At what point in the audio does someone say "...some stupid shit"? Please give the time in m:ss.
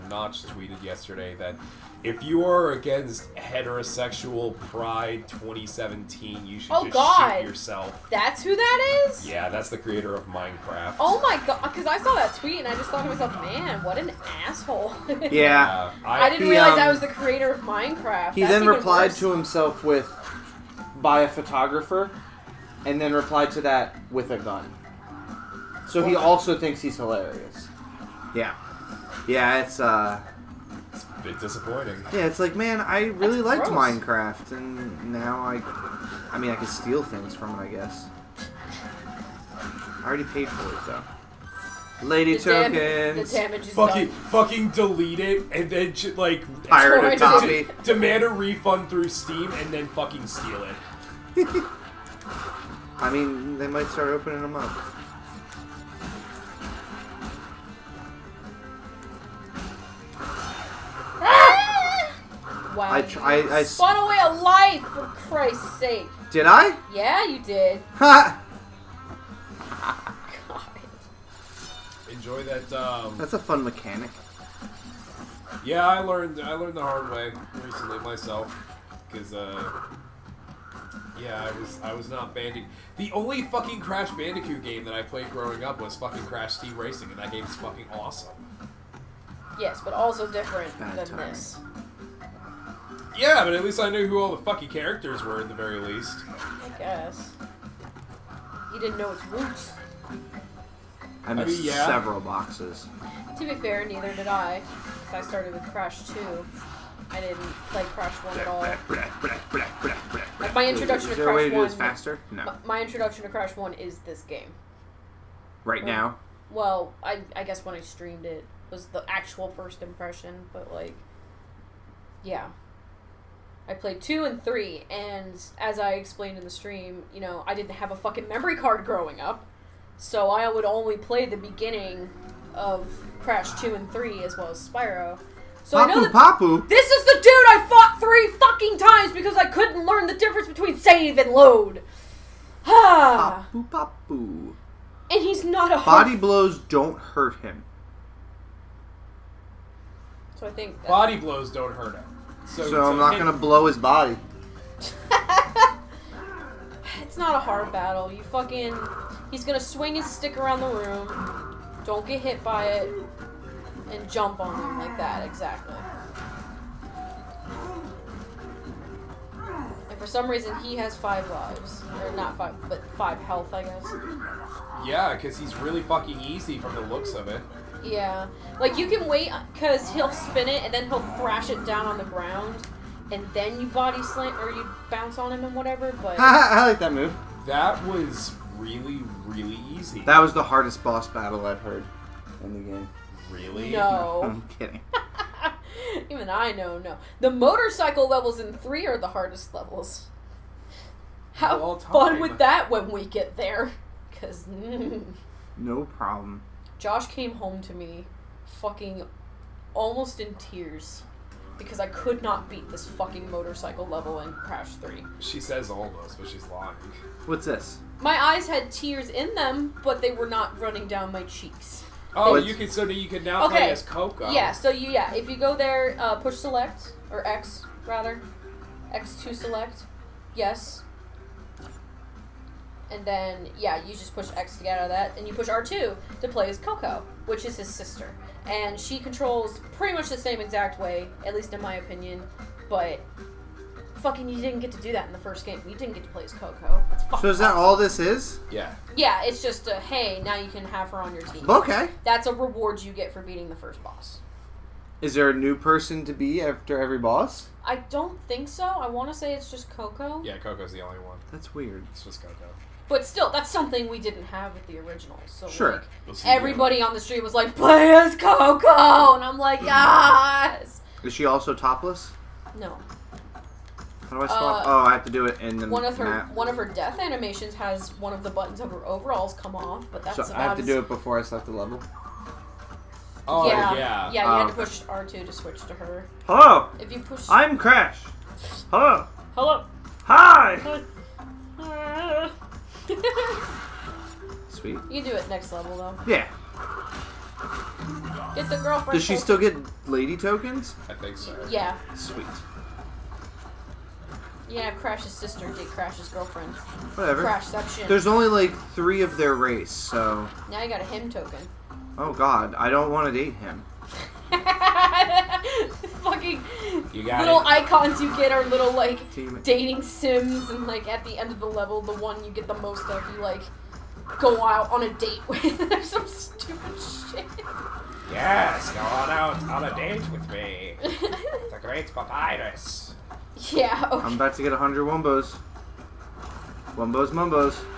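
5:25.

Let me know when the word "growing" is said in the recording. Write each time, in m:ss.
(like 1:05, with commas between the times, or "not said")
1:25, 2:08.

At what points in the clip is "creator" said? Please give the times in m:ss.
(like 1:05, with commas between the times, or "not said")
0:09, 0:17.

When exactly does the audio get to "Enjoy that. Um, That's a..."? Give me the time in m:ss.
1:12.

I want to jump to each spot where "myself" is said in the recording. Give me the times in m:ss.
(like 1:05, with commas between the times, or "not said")
0:13, 1:17.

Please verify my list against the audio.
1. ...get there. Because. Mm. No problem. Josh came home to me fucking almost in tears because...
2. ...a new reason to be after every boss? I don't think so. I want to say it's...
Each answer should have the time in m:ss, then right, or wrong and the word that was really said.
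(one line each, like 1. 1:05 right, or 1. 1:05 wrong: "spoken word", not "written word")
1. 3:23 right
2. 4:15 wrong: "person", not "reason".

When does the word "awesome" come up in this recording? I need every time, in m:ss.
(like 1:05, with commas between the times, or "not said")
1:27, 4:07.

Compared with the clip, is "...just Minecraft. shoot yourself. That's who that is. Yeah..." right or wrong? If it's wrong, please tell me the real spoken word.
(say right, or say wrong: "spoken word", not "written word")
wrong: "God", not "Minecraft".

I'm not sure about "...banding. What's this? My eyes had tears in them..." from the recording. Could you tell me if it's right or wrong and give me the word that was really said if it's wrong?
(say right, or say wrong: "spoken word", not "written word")
wrong: "lying", not "banding".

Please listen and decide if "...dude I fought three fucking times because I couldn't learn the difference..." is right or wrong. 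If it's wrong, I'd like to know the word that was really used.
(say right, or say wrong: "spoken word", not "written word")
right.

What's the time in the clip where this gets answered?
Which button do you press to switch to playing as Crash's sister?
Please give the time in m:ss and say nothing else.
3:55.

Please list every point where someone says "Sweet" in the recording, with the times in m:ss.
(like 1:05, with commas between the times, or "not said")
4:54, 5:01.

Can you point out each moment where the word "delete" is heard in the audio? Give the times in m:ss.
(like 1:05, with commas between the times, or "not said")
0:44.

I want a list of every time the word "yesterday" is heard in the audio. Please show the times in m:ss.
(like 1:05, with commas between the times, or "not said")
0:00.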